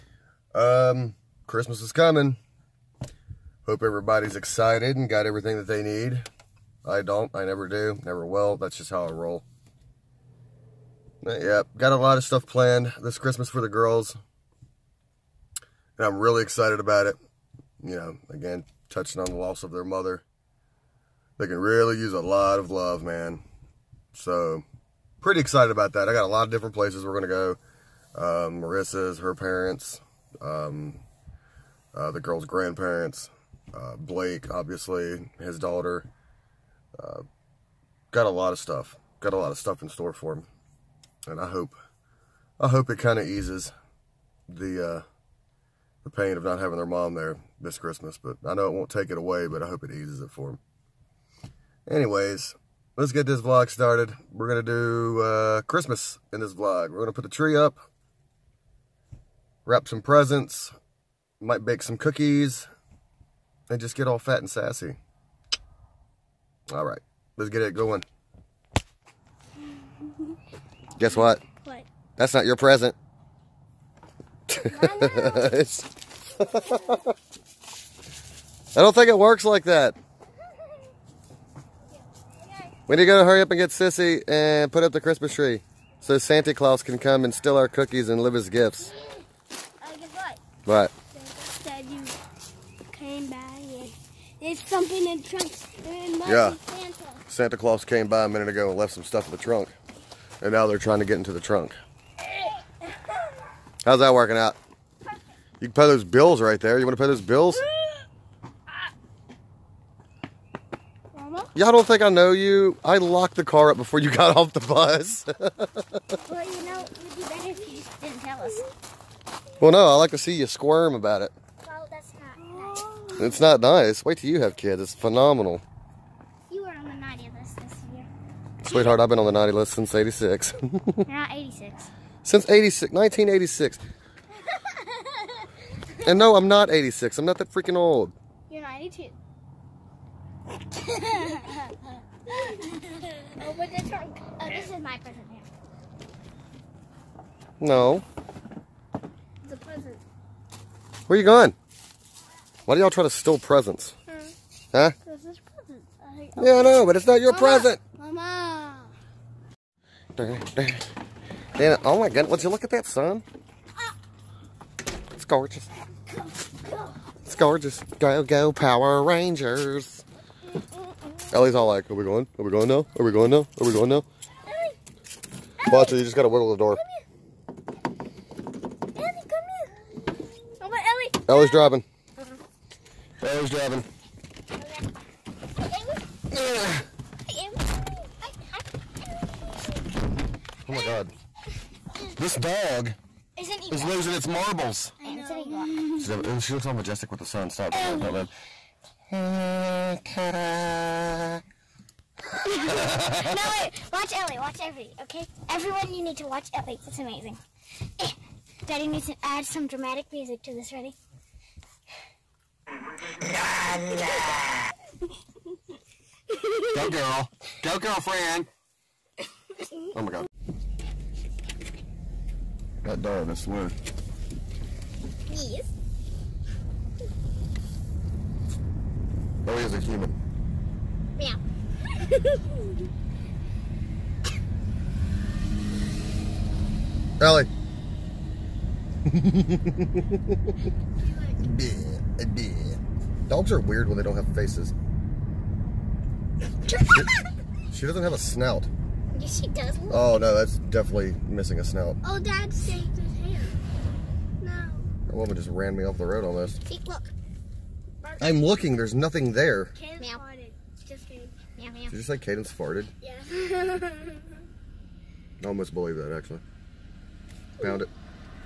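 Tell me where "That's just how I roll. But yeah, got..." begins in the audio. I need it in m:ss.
0:08.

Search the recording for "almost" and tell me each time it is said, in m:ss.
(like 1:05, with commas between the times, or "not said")
4:16, 4:25.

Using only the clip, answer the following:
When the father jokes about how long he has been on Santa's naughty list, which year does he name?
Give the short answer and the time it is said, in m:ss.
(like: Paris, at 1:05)
1986, at 2:12.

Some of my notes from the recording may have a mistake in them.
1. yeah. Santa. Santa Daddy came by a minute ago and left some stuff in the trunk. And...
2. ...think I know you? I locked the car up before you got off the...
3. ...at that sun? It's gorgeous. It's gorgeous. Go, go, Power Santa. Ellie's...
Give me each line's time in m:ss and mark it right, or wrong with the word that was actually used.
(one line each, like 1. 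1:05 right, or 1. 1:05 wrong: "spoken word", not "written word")
1. 1:36 wrong: "Claus", not "Daddy"
2. 1:51 right
3. 2:42 wrong: "Rangers", not "Santa".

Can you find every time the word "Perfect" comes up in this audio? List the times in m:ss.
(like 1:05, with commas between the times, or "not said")
1:45.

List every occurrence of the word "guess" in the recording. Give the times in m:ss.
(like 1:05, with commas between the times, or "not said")
1:10, 1:29.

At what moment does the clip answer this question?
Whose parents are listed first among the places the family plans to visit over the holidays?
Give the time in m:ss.
0:28.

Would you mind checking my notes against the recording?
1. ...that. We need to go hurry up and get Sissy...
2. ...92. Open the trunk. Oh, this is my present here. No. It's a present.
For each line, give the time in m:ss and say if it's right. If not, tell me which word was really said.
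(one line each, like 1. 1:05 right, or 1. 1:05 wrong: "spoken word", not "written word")
1. 1:19 right
2. 2:18 right.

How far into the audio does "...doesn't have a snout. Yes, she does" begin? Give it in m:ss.
4:07.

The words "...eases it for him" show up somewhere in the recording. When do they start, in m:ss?
0:49.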